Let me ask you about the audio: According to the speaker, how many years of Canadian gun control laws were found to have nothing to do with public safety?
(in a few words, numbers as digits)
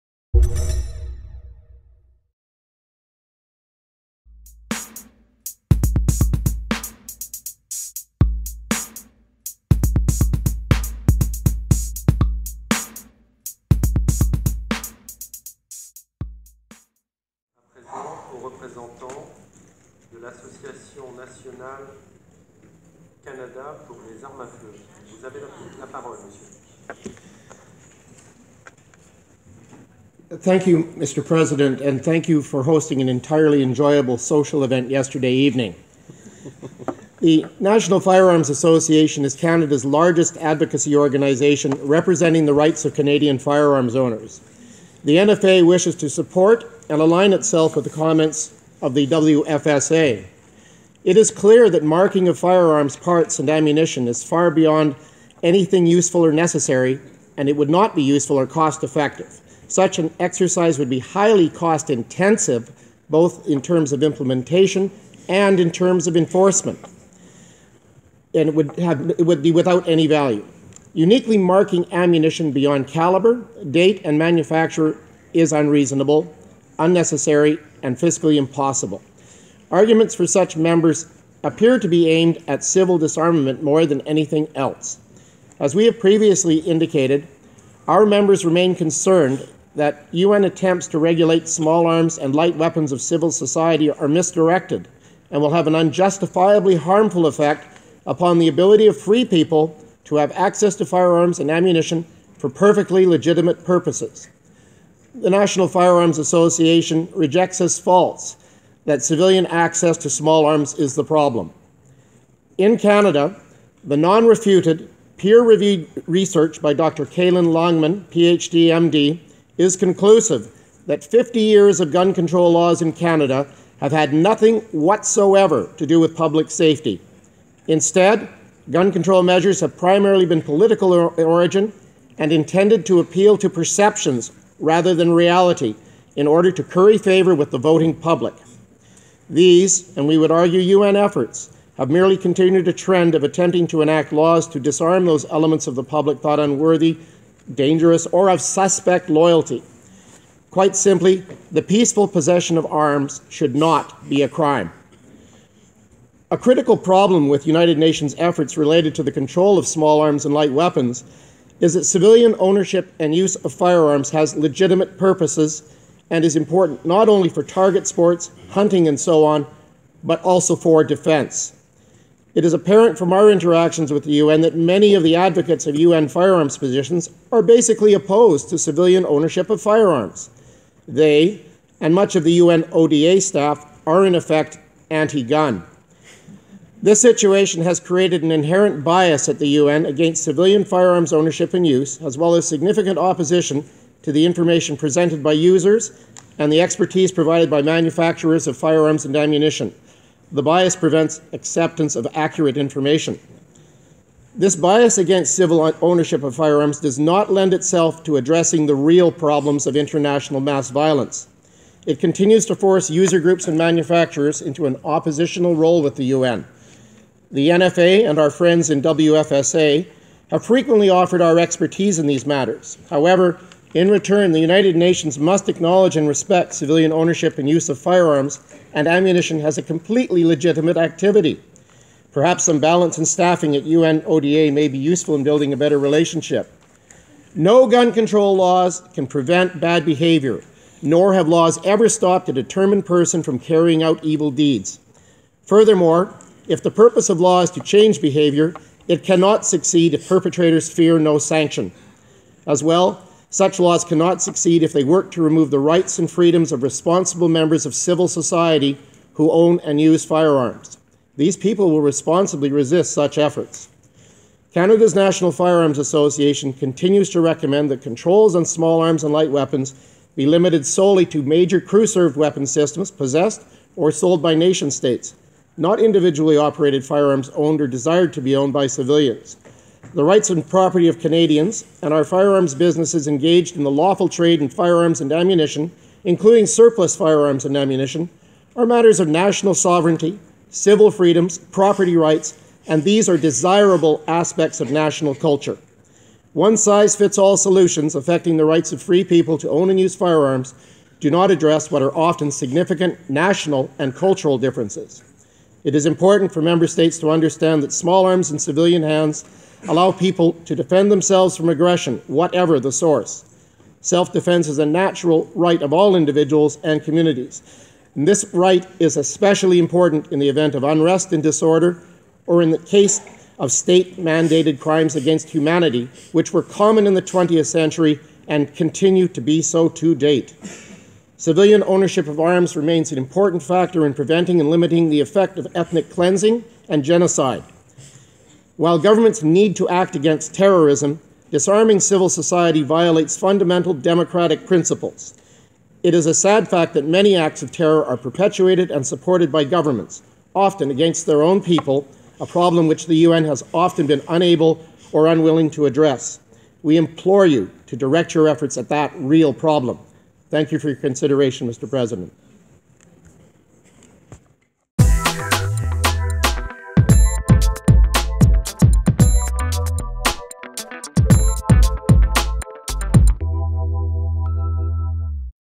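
50 years.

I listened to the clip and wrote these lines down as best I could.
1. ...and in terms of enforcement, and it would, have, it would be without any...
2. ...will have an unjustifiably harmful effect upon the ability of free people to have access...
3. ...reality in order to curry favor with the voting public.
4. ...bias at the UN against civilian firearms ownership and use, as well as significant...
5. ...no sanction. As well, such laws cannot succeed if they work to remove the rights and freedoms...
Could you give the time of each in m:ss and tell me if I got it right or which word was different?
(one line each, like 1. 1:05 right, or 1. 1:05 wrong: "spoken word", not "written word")
1. 1:05 right
2. 1:35 right
3. 2:15 right
4. 3:08 right
5. 4:10 right.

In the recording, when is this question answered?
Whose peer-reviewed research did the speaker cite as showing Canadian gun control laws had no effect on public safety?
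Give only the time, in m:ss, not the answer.
1:56.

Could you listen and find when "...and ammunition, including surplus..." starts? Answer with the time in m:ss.
4:45.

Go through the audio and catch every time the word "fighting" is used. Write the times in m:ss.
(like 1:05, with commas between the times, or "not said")
not said.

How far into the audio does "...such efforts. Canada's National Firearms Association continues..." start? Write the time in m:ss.
4:22.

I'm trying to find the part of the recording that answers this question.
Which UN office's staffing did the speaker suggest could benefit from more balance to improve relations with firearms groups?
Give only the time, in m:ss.
3:53.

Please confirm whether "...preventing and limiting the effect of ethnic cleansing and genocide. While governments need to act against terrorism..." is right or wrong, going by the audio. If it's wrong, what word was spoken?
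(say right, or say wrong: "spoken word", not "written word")
right.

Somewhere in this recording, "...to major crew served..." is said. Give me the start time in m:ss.
4:31.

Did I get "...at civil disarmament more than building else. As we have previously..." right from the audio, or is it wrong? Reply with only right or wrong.
wrong.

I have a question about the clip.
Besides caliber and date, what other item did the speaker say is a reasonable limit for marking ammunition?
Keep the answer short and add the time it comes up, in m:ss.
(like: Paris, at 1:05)
manufacturer, at 1:14.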